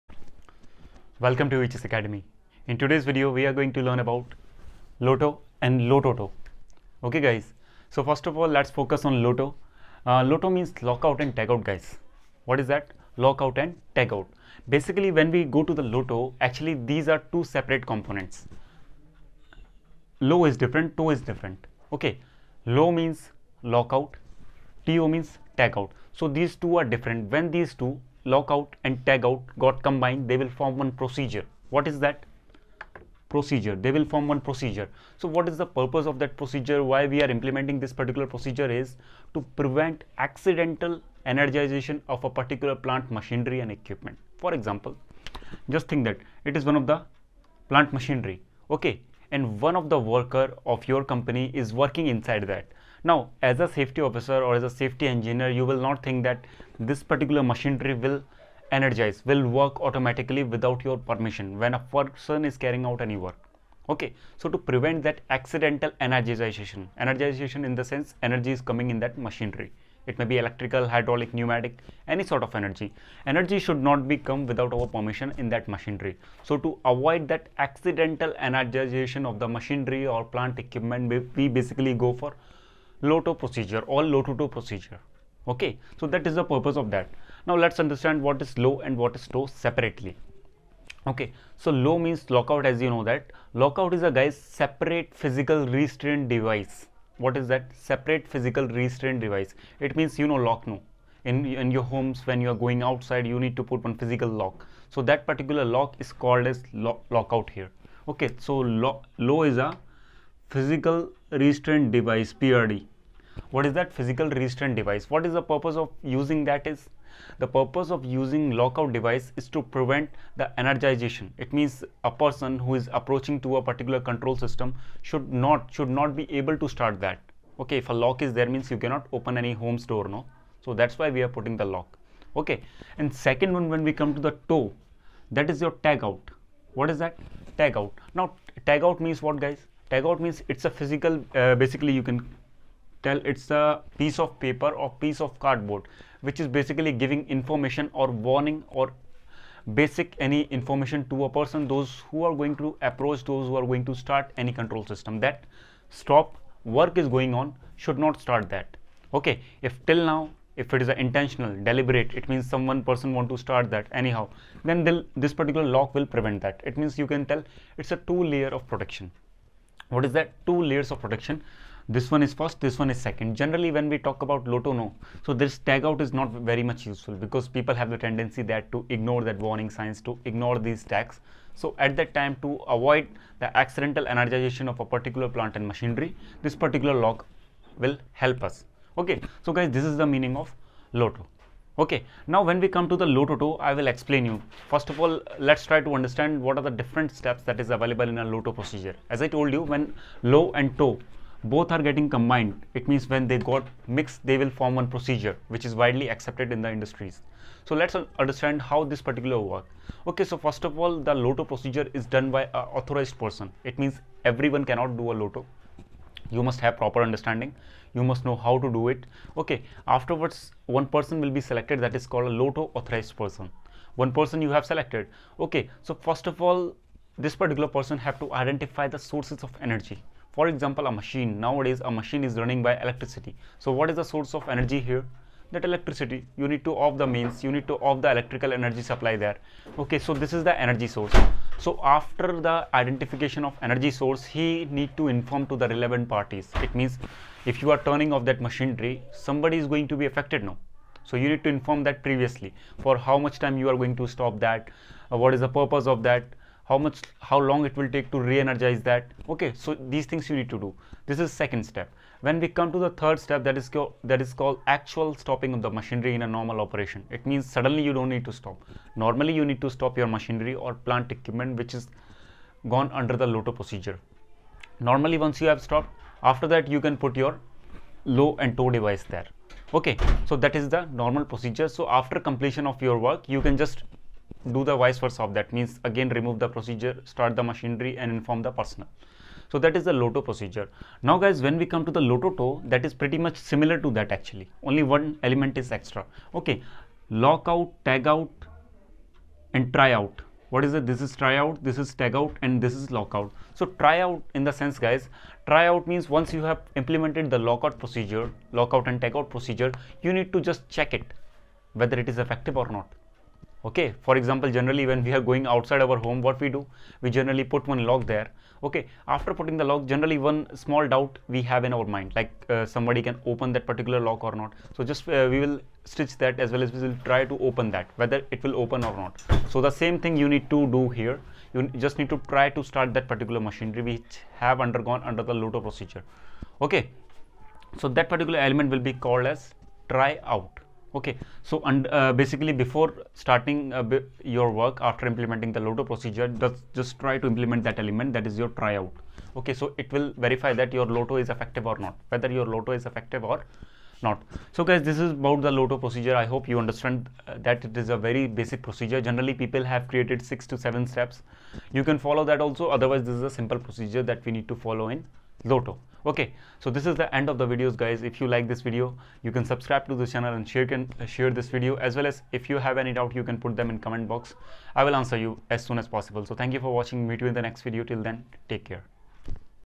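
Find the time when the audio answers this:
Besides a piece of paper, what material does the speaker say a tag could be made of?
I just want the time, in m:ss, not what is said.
2:25.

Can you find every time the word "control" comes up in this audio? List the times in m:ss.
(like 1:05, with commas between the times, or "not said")
2:04, 2:34.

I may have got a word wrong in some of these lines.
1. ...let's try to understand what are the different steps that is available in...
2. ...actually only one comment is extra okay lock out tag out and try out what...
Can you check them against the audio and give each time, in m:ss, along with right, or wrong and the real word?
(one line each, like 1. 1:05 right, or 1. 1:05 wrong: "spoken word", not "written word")
1. 3:15 right
2. 4:54 wrong: "element", not "comment".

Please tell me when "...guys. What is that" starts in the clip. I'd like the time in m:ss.
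0:11.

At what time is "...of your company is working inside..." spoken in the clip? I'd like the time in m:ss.
0:50.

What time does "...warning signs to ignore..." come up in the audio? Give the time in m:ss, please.
2:59.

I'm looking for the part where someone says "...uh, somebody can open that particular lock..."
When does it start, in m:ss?
5:22.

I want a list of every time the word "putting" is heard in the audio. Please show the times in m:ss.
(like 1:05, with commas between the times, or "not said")
2:11, 5:19.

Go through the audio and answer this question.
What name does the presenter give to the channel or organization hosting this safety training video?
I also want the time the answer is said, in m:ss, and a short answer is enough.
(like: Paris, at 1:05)
EHS Academy, at 0:01.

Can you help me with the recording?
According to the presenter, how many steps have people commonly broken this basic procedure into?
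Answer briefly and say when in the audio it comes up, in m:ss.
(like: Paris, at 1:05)
6 to 7, at 6:00.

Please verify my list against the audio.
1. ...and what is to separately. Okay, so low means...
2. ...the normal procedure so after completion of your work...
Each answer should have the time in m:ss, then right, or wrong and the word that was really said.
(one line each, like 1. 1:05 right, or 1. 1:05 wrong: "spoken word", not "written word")
1. 1:28 right
2. 4:40 right.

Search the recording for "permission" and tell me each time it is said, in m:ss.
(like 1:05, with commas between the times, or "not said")
1:00, 1:14.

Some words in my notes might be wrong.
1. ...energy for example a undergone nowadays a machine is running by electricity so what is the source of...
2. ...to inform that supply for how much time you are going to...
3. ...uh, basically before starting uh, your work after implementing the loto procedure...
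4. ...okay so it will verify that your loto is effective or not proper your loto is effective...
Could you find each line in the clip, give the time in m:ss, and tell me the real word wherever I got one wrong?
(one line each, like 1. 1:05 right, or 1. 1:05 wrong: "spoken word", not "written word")
1. 3:49 wrong: "machine", not "undergone"
2. 4:11 wrong: "previously", not "supply"
3. 5:41 right
4. 5:49 wrong: "whether", not "proper".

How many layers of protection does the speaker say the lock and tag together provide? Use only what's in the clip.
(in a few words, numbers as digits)
2.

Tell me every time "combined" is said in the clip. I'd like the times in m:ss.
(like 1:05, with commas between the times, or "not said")
0:29, 3:22.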